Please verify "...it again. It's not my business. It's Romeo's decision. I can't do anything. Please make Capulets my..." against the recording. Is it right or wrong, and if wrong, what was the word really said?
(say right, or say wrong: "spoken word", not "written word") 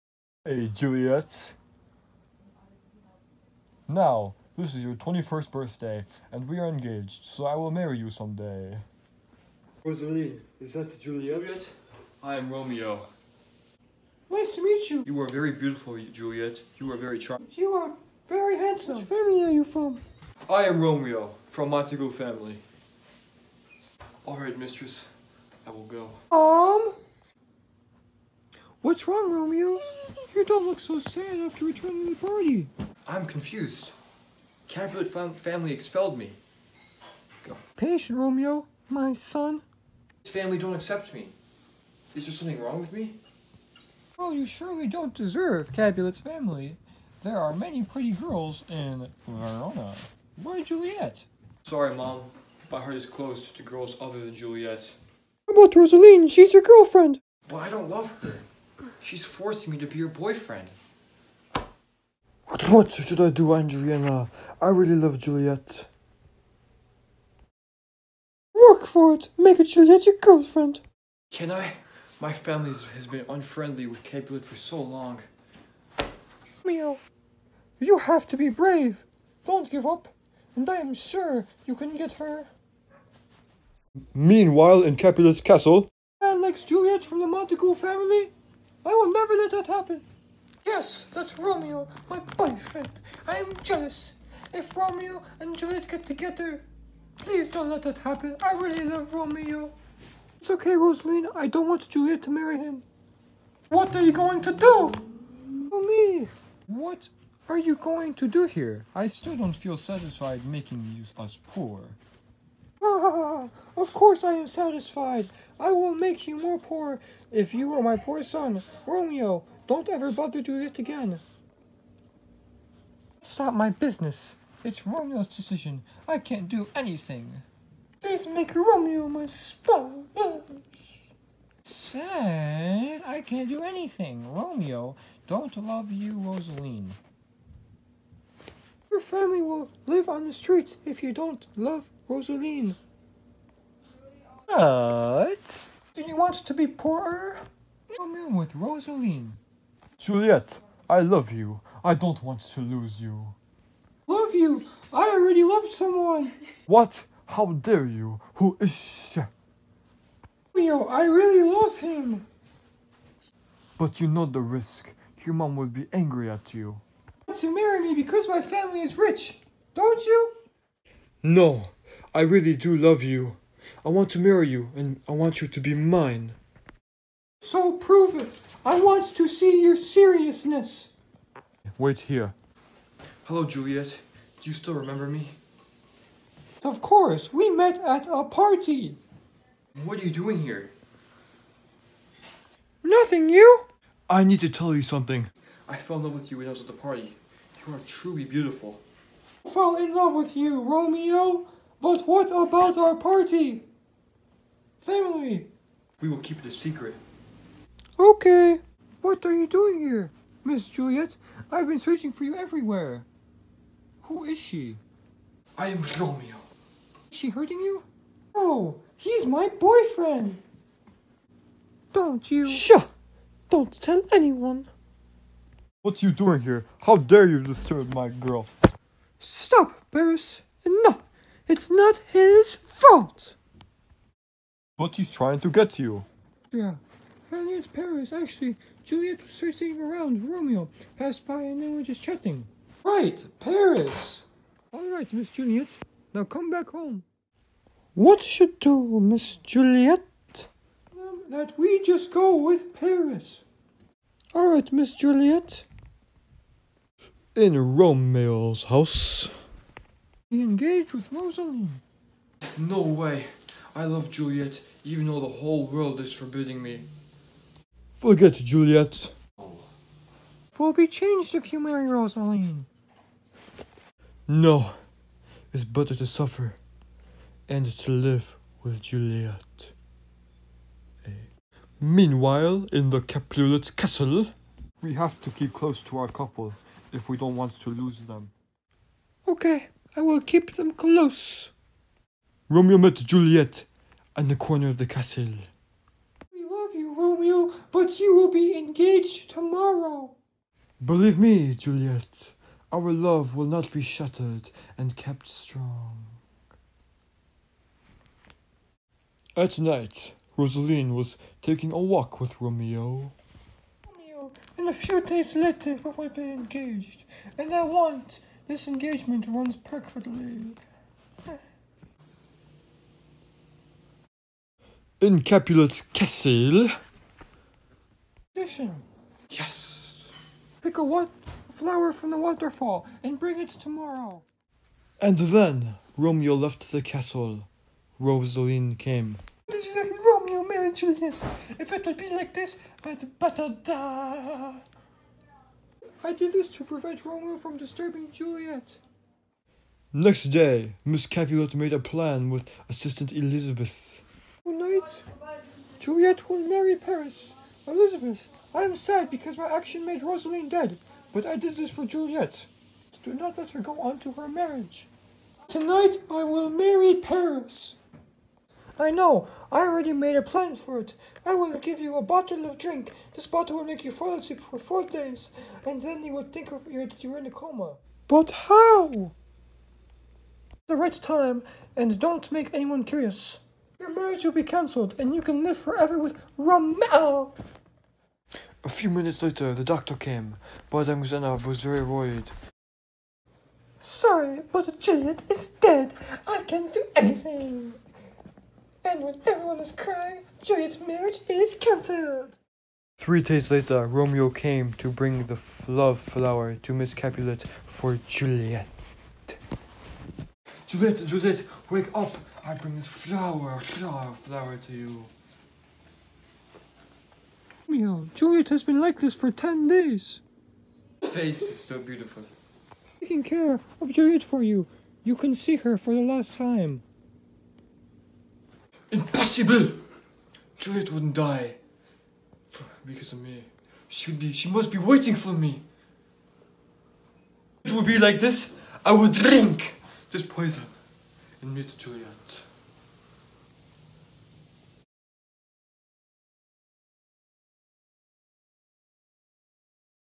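wrong: "Romeo", not "Capulets".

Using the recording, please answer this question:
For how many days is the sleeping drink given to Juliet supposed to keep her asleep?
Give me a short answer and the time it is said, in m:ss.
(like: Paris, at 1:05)
4, at 6:14.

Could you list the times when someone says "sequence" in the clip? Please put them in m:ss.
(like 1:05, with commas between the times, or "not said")
not said.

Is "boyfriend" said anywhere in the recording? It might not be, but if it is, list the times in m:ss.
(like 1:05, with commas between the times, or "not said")
1:00, 1:32, 3:39.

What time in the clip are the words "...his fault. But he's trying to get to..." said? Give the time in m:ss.
3:52.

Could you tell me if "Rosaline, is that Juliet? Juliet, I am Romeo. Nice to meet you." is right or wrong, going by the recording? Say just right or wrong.
right.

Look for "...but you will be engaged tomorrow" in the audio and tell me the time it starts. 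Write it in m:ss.
4:57.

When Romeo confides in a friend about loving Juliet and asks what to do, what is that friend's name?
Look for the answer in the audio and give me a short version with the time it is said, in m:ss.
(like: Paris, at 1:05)
Andriana, at 1:03.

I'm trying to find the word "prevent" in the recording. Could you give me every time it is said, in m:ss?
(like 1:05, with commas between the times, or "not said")
5:46.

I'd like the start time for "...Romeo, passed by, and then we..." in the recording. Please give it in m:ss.
4:00.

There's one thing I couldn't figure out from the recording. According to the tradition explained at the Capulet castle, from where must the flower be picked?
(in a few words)
the waterfall.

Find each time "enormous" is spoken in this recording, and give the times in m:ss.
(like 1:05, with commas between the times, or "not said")
not said.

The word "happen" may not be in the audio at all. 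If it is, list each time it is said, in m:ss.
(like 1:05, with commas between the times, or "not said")
1:29, 1:37.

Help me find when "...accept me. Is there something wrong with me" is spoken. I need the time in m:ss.
0:40.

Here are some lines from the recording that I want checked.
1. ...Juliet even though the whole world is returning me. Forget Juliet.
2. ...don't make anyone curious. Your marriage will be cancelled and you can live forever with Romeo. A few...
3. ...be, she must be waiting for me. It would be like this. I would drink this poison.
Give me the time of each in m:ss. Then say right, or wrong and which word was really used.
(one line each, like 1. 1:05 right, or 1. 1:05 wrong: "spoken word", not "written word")
1. 4:24 wrong: "forbidding", not "returning"
2. 6:21 right
3. 7:14 right.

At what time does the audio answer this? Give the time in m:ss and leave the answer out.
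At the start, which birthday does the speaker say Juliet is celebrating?
0:04.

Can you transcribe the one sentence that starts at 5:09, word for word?
At night, Rosaline was taking a walk with Romeo.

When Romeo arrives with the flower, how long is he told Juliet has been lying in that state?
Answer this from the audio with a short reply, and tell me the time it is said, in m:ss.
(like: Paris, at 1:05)
10 days, at 6:59.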